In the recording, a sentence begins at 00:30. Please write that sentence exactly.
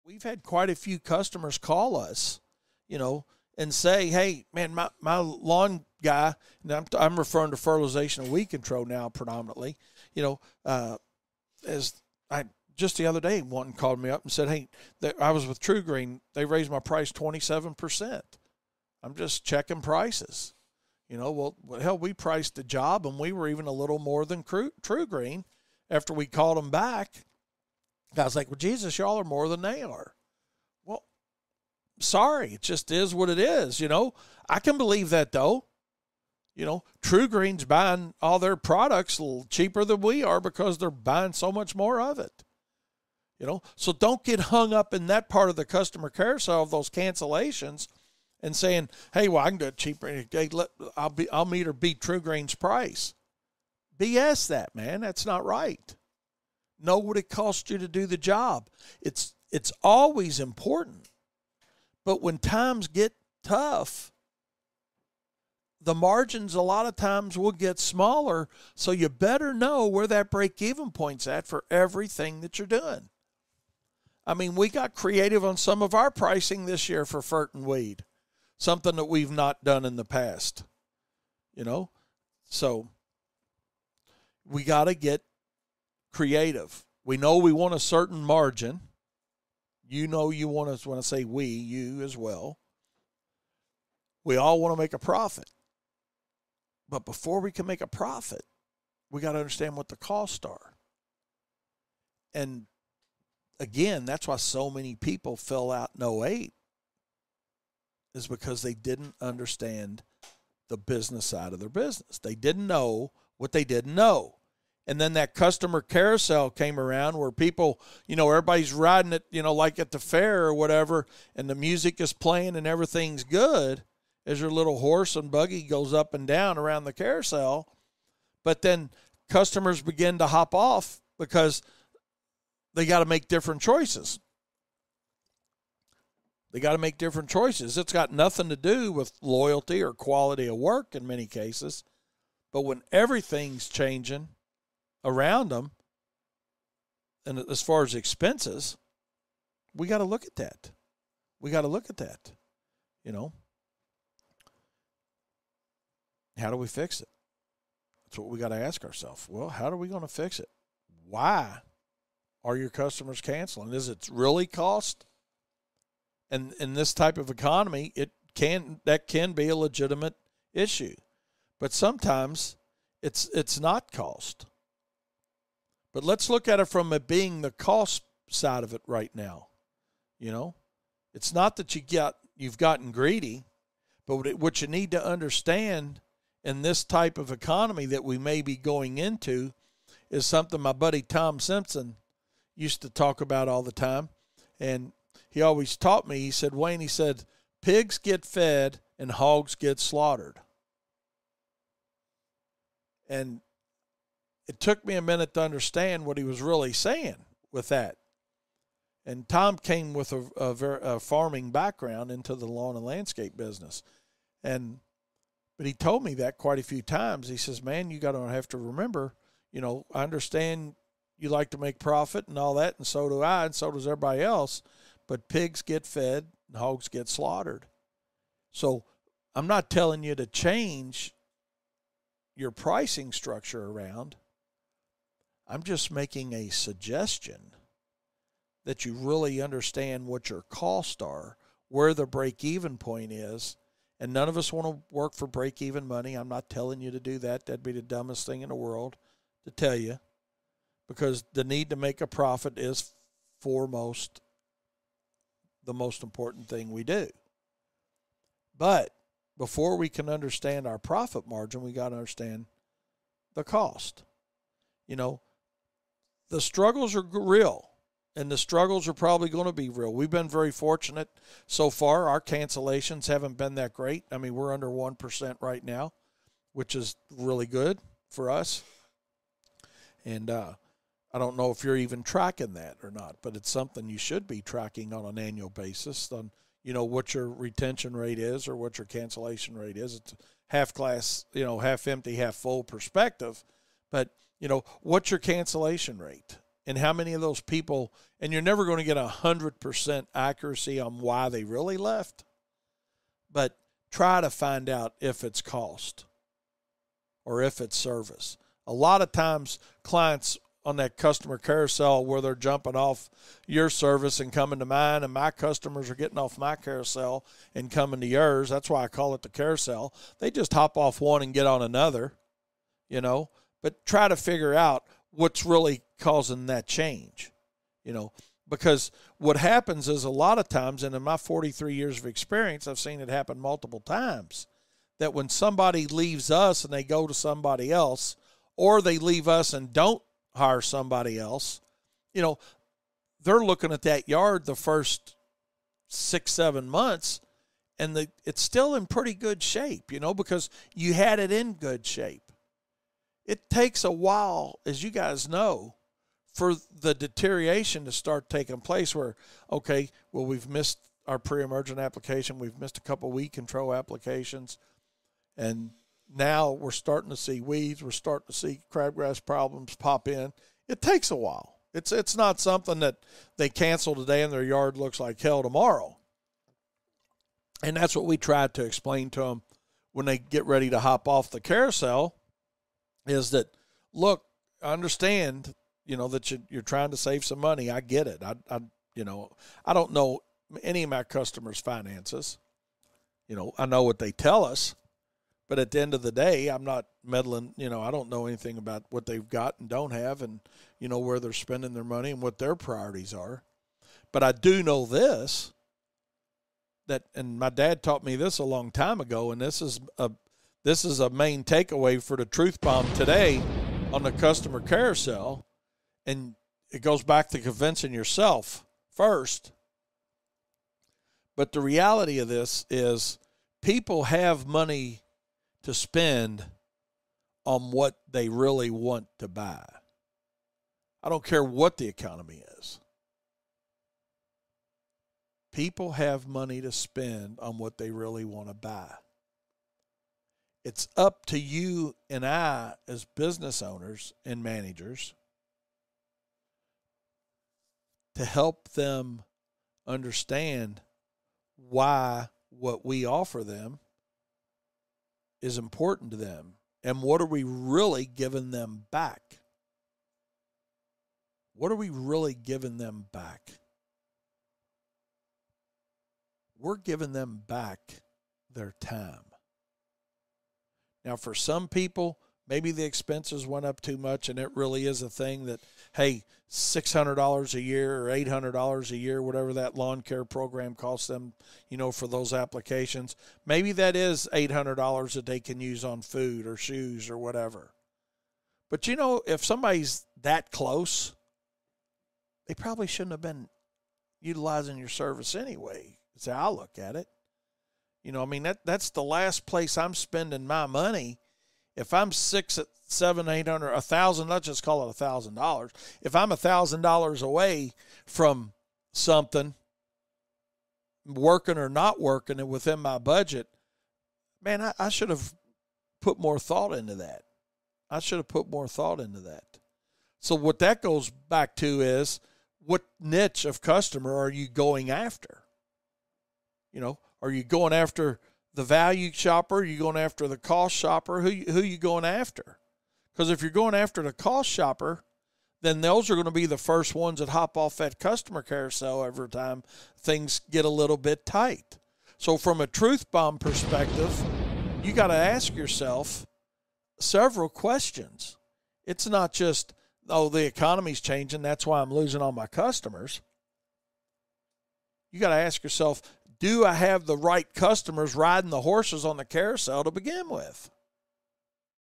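Well, sorry, it just is what it is.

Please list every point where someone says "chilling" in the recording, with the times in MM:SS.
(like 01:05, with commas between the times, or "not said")
not said.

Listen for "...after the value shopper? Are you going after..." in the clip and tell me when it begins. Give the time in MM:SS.
08:47.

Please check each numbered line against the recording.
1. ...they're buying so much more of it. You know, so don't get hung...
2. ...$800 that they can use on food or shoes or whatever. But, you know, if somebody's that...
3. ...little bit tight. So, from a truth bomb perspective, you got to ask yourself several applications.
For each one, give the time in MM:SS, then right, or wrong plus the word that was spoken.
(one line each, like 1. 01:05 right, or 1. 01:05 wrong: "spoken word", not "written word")
1. 00:40 right
2. 08:04 right
3. 09:00 wrong: "questions", not "applications".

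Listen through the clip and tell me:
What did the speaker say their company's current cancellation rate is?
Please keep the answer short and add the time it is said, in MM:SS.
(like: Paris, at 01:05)
under 1%, at 04:34.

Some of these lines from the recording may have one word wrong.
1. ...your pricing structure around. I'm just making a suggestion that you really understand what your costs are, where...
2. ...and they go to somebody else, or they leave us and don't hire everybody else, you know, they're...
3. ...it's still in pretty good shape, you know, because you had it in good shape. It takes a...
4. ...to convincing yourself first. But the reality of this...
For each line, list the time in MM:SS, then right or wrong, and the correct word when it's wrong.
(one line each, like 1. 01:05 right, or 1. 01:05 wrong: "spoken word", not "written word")
1. 03:52 right
2. 05:36 wrong: "somebody", not "everybody"
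3. 05:48 right
4. 06:57 right.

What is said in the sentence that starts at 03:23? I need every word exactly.
And it took me a minute to understand what he was really saying with that.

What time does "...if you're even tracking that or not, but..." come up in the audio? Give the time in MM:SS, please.
04:41.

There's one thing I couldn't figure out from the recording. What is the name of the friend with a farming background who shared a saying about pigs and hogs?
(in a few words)
Tom Simpson.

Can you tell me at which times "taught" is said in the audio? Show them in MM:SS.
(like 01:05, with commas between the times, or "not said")
03:15, 06:47.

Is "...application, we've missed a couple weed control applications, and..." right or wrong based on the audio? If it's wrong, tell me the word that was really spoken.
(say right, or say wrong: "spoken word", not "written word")
right.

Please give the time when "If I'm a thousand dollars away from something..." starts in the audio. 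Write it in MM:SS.
08:26.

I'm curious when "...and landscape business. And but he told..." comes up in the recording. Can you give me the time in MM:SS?
03:32.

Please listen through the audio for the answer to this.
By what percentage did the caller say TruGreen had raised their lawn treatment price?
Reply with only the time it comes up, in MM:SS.
00:17.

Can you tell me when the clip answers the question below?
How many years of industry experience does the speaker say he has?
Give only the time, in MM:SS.
05:31.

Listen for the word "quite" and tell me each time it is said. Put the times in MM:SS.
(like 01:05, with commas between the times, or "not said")
00:00, 03:36.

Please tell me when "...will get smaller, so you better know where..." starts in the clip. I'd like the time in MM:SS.
01:07.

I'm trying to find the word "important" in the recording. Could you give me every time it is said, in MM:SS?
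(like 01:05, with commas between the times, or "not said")
01:00, 04:16, 07:35.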